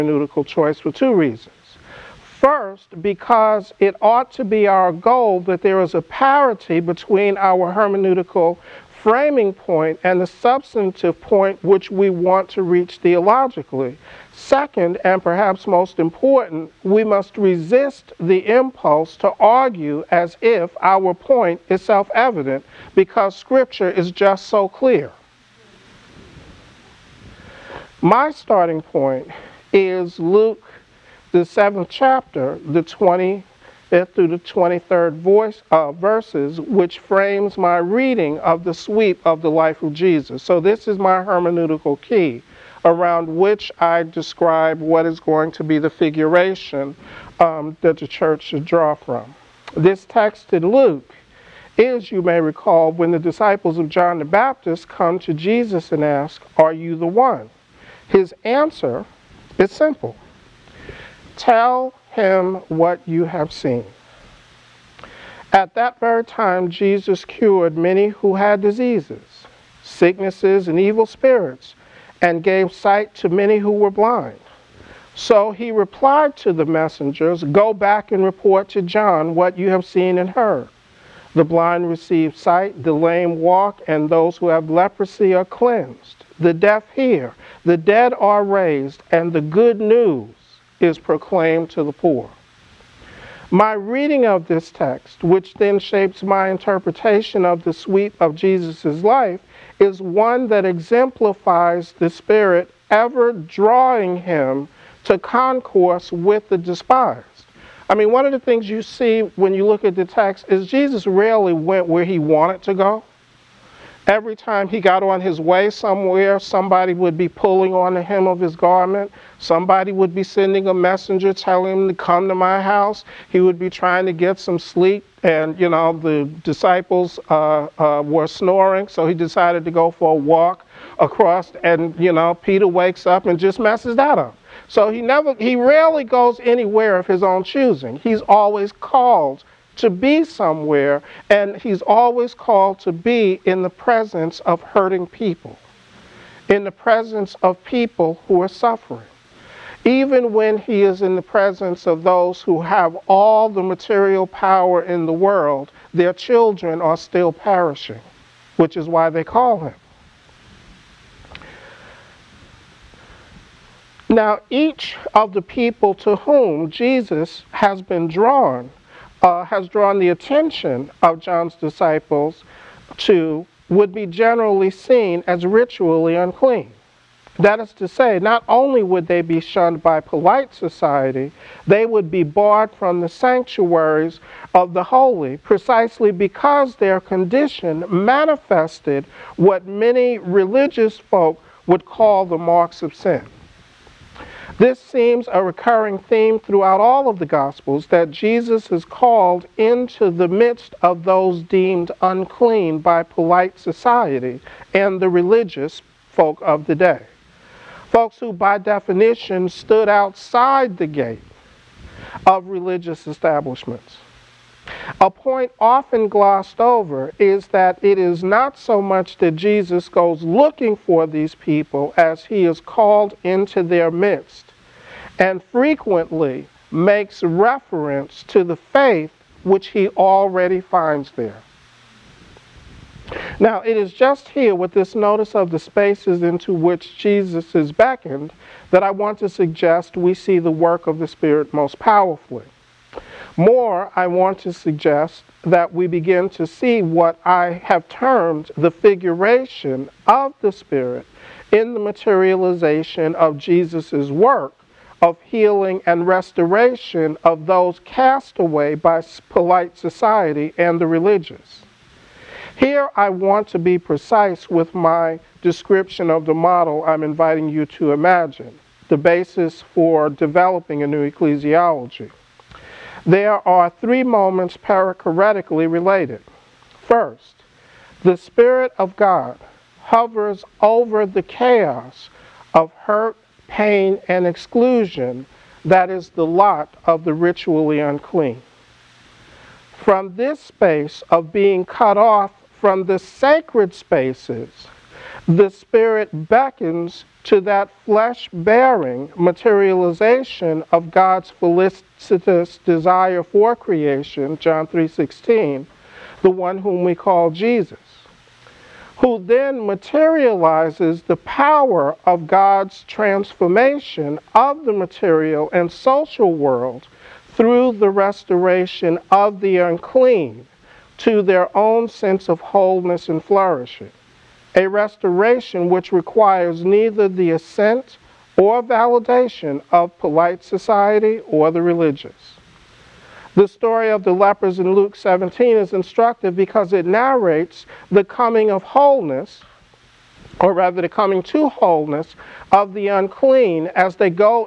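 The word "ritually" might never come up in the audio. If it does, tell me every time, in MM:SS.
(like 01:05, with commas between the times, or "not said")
02:55, 04:47.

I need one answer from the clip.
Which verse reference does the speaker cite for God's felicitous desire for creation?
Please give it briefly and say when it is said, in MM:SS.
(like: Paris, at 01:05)
John 3:16, at 05:04.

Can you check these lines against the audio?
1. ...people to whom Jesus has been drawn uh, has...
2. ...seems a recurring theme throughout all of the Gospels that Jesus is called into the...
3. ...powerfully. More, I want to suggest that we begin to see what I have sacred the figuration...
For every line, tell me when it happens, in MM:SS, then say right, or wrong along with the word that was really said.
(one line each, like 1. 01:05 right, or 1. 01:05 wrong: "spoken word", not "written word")
1. 02:45 right
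2. 03:14 right
3. 04:01 wrong: "termed", not "sacred".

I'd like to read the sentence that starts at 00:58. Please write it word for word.
His answer is simple Tell him what you have seen.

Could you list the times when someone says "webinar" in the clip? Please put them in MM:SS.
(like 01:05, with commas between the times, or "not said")
not said.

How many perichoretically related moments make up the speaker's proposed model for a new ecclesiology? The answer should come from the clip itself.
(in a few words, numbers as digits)
3.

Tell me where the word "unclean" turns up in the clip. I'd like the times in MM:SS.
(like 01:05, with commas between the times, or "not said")
02:56, 03:22, 04:47, 05:19, 05:42.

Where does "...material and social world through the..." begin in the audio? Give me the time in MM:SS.
05:14.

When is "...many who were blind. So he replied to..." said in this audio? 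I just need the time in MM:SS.
01:13.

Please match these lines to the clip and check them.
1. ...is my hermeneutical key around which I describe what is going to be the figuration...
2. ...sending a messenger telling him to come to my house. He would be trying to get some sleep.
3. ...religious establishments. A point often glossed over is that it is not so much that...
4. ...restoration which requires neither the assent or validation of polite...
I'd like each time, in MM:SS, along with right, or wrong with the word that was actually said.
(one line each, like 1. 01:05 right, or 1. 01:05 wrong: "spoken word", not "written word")
1. 00:40 right
2. 02:00 right
3. 03:32 right
4. 05:24 right.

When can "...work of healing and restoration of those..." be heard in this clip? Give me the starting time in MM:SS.
04:14.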